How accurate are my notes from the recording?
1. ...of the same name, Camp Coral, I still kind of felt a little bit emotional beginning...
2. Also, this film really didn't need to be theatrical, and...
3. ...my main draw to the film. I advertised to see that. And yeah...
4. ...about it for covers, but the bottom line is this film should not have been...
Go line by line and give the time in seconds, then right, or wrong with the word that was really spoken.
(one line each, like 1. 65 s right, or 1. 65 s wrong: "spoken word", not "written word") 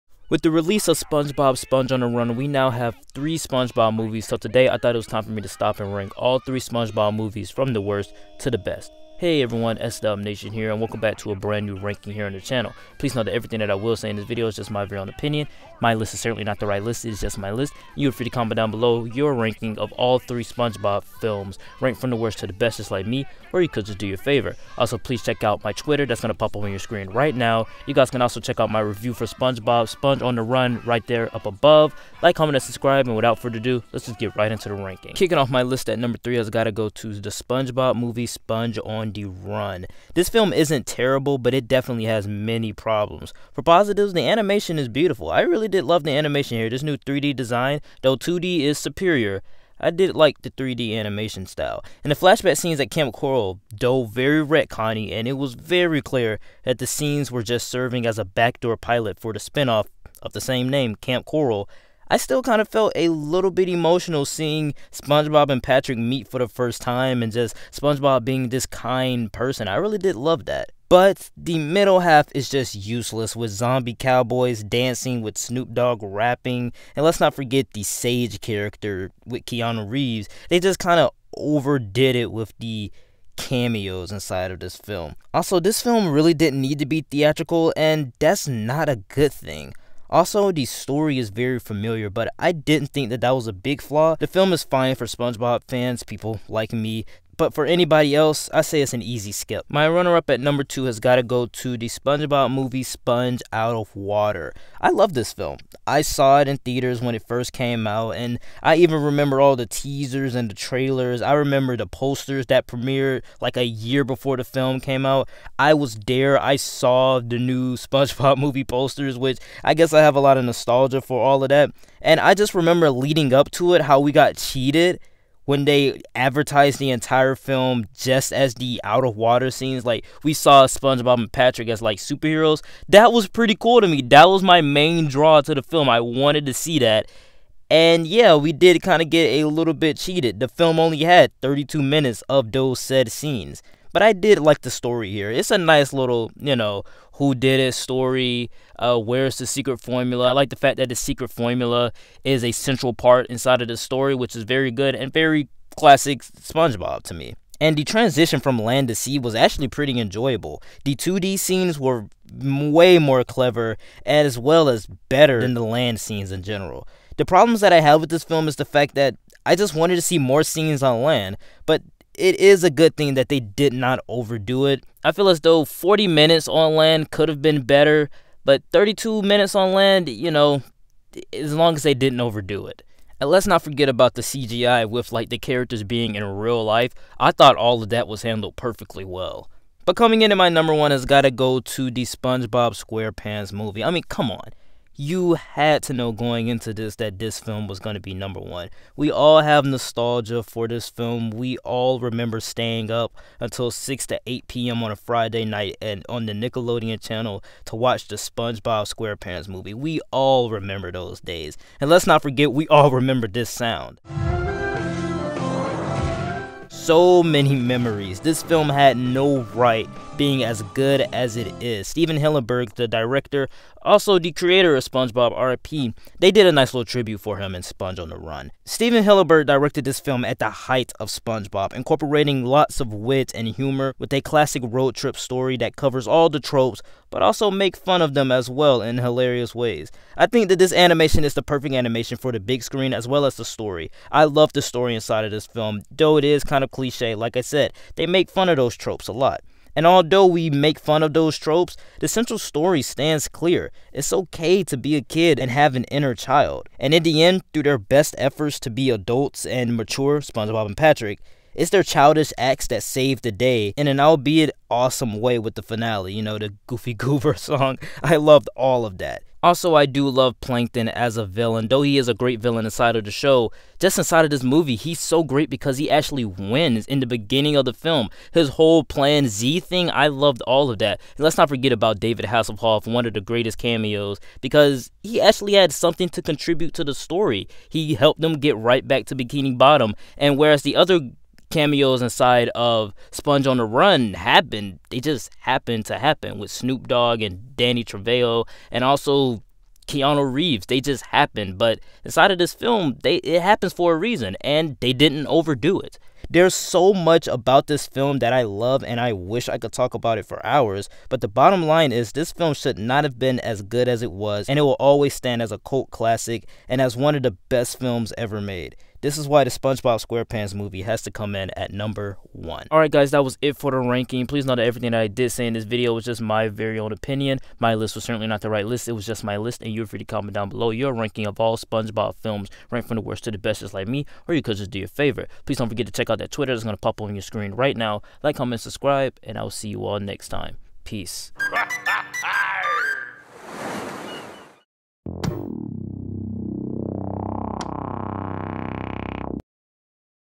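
1. 60 s wrong: "seeing", not "beginning"
2. 85 s right
3. 134 s wrong: "wanted", not "advertised"
4. 309 s wrong: "hours", not "covers".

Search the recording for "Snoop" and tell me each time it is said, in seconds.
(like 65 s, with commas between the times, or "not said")
75 s, 296 s.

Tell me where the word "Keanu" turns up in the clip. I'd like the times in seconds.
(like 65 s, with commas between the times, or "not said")
79 s, 299 s.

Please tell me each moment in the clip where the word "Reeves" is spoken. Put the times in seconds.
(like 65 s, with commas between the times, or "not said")
79 s, 300 s.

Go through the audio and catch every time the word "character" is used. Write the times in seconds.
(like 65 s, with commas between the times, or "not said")
78 s, 185 s.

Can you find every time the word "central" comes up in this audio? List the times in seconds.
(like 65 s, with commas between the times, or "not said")
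152 s, 252 s.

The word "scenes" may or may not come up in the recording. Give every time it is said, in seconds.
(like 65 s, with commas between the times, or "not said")
52 s, 56 s, 129 s, 143 s, 161 s, 165 s, 170 s.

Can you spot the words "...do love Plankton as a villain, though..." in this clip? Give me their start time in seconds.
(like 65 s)
269 s.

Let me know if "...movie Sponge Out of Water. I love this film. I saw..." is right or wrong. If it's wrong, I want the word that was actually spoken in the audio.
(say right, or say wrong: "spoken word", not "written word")
right.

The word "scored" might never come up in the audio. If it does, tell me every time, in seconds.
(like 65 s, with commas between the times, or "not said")
not said.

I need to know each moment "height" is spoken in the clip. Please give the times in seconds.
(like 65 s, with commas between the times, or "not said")
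230 s.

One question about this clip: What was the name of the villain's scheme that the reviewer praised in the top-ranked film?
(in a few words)
Plan Z.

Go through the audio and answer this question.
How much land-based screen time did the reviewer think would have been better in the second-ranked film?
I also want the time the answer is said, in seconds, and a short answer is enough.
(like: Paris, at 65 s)
40 minutes, at 175 s.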